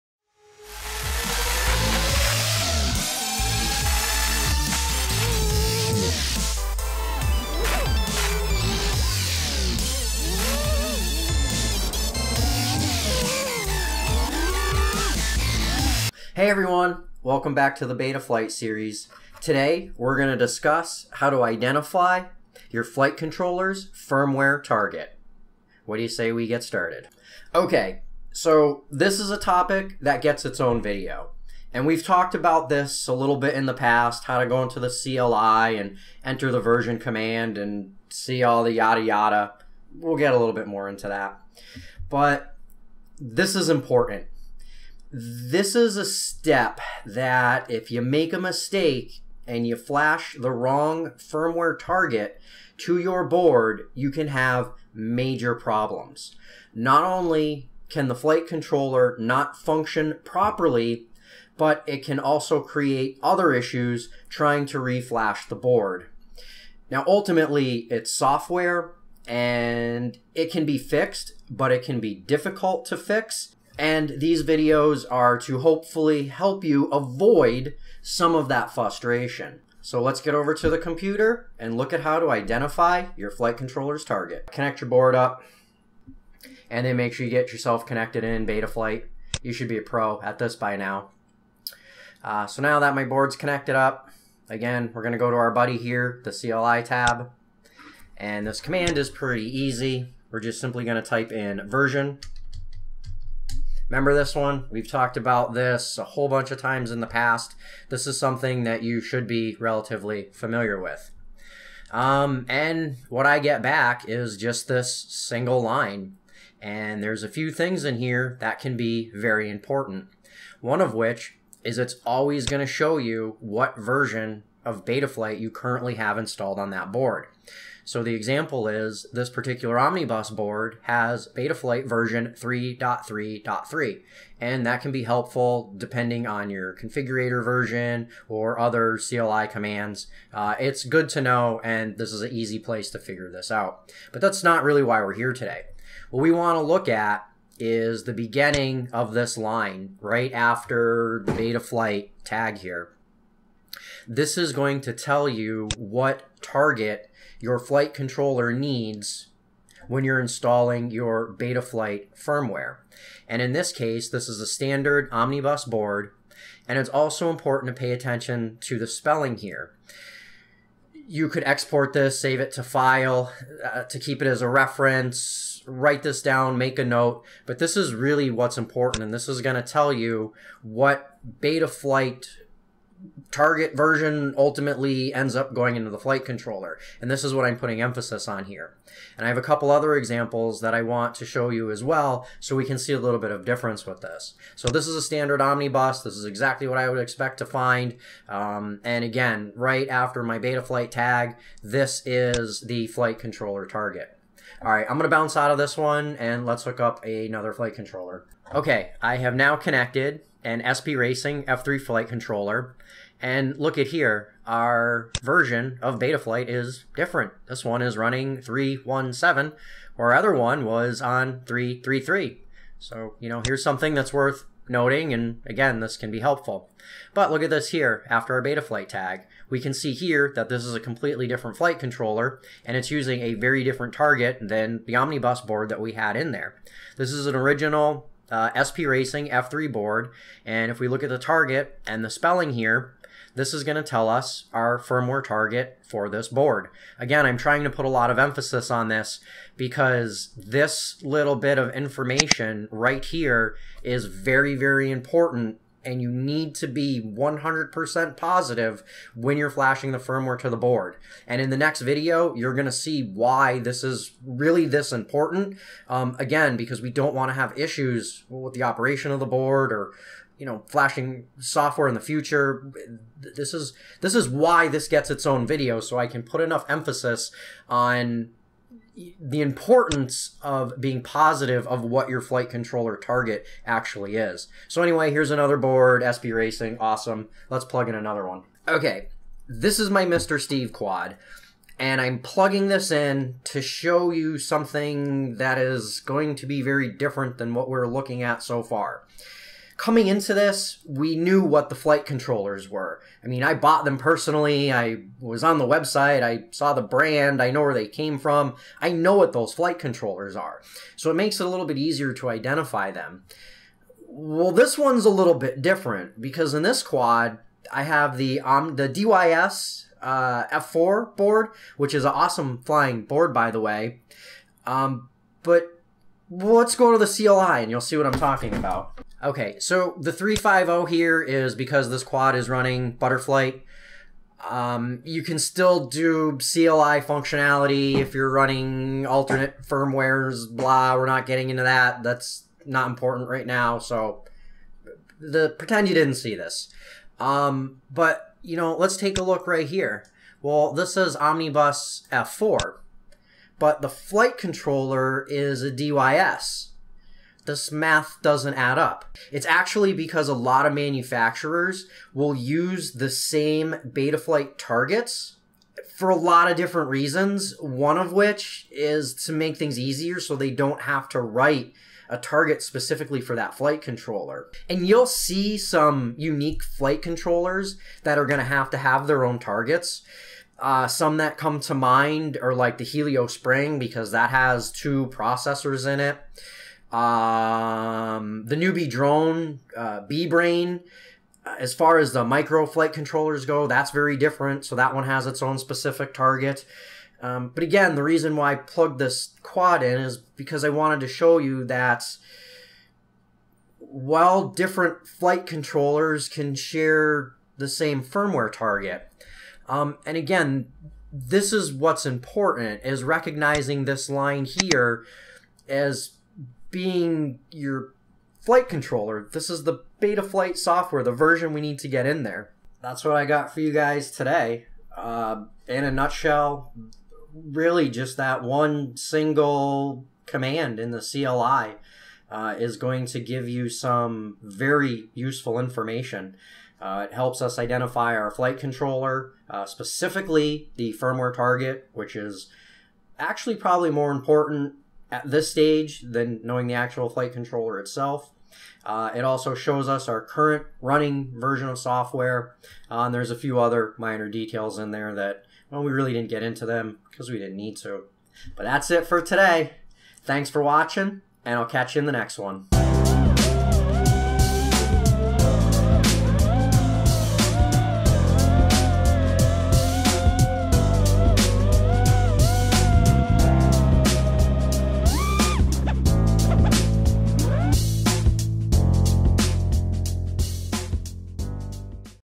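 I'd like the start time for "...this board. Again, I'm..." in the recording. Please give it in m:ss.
4:06.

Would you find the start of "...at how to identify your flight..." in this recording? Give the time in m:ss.
1:21.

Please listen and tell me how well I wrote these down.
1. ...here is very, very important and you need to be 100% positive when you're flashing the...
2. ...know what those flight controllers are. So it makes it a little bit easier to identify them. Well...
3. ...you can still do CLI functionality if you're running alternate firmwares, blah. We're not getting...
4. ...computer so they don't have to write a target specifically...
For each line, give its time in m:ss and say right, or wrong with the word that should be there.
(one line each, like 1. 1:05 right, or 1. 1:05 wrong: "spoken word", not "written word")
1. 4:13 right
2. 5:08 right
3. 5:35 right
4. 6:09 wrong: "easier", not "computer".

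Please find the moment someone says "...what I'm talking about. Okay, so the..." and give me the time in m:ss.
5:27.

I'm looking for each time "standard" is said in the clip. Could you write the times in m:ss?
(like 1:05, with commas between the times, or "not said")
2:44, 3:15.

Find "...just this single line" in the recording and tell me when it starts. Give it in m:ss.
1:54.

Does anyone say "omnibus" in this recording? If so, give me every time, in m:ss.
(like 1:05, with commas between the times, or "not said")
2:09, 2:45, 3:15, 3:54, 5:51.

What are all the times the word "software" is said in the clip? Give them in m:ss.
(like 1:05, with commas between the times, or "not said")
1:08, 4:31, 7:00, 7:31.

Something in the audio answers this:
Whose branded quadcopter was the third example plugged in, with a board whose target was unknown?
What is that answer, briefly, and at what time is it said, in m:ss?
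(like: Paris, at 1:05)
Mr. Steele, at 4:50.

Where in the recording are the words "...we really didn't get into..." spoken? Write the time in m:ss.
7:35.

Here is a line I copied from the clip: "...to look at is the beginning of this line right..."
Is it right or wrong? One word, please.
right.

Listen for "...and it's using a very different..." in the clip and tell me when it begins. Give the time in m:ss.
3:52.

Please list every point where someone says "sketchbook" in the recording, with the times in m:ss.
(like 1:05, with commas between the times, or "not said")
not said.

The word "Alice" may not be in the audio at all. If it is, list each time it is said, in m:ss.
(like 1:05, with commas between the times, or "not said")
not said.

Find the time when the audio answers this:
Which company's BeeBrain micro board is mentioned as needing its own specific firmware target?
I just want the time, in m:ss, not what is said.
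6:28.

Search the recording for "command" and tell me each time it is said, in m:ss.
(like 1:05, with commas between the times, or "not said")
0:36, 1:38, 2:19, 7:10.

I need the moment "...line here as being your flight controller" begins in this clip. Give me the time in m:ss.
6:54.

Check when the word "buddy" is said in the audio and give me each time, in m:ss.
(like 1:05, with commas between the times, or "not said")
1:35.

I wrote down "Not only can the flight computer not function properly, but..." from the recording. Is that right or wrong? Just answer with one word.
wrong.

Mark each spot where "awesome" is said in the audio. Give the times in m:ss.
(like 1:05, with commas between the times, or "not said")
4:46, 5:22.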